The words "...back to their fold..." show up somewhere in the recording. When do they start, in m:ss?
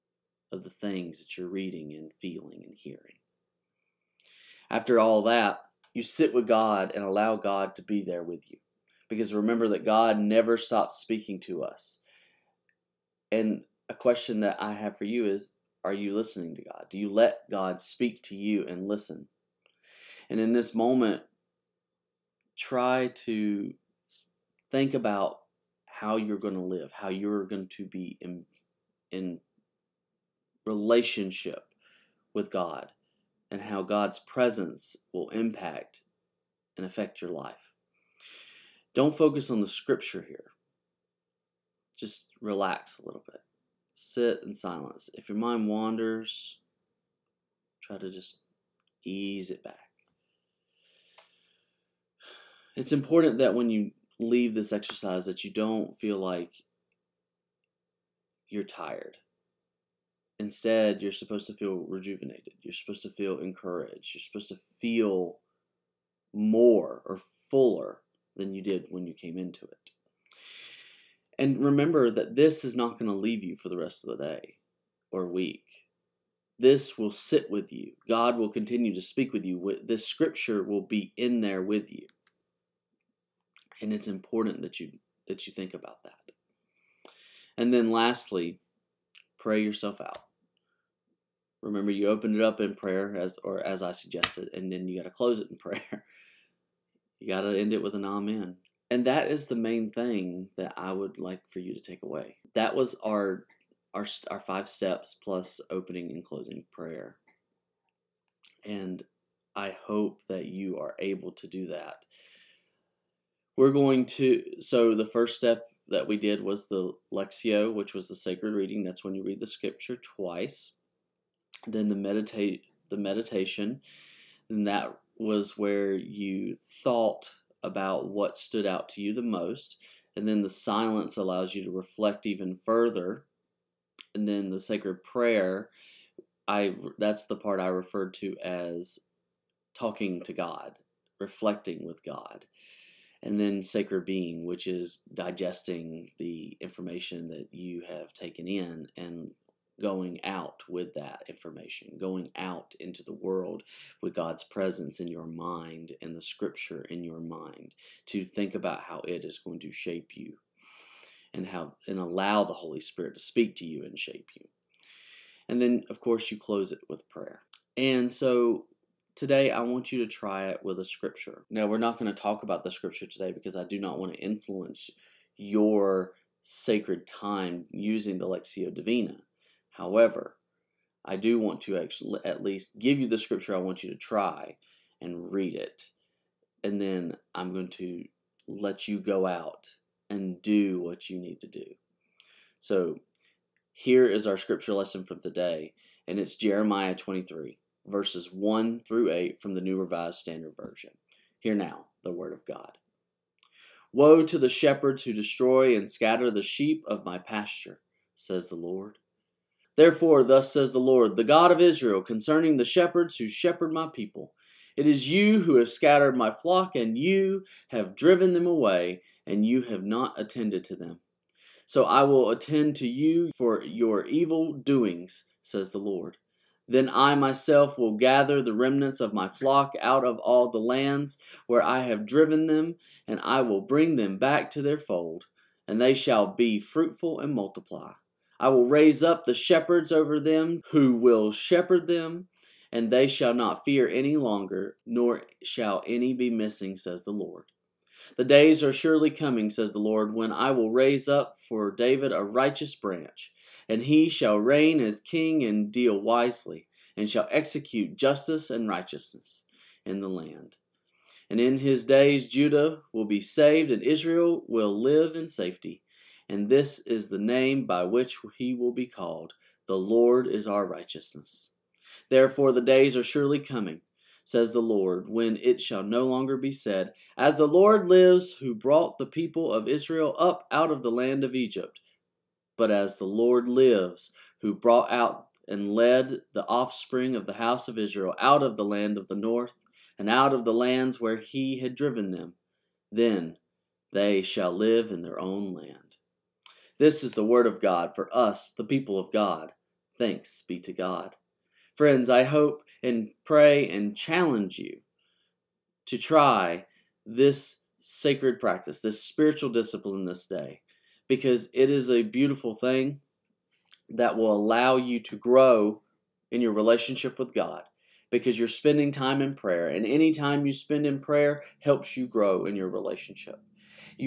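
3:54.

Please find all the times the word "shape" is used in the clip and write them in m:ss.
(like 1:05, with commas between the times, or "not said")
2:39, 2:43.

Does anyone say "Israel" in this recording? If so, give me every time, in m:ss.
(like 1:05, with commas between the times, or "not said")
3:31, 4:23, 4:39, 4:47.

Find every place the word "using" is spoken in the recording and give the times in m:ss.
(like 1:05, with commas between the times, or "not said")
2:57.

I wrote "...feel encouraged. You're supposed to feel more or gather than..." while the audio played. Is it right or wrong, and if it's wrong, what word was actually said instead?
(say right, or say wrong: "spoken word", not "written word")
wrong: "fuller", not "gather".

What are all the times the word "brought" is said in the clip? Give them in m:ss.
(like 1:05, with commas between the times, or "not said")
4:38, 4:44.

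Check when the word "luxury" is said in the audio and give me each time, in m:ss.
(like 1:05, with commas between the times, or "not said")
not said.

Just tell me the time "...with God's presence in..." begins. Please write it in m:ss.
2:34.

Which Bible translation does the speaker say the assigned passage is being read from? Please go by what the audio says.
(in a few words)
New Revised Standard Version.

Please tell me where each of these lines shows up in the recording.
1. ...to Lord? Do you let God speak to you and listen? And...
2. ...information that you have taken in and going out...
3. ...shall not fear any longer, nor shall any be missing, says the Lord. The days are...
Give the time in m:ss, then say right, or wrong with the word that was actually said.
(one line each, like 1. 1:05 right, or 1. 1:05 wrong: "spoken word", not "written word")
1. 0:16 wrong: "God", not "Lord"
2. 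2:26 right
3. 4:03 right.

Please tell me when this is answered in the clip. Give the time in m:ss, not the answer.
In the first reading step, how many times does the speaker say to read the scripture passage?
1:59.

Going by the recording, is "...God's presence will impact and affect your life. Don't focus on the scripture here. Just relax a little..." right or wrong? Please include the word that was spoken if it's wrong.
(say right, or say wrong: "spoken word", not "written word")
right.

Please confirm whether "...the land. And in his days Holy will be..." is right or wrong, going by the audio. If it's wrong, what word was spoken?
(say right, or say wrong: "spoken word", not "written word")
wrong: "Judah", not "Holy".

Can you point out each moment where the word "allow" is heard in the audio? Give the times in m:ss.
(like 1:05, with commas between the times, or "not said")
0:07, 2:11, 2:41, 5:14.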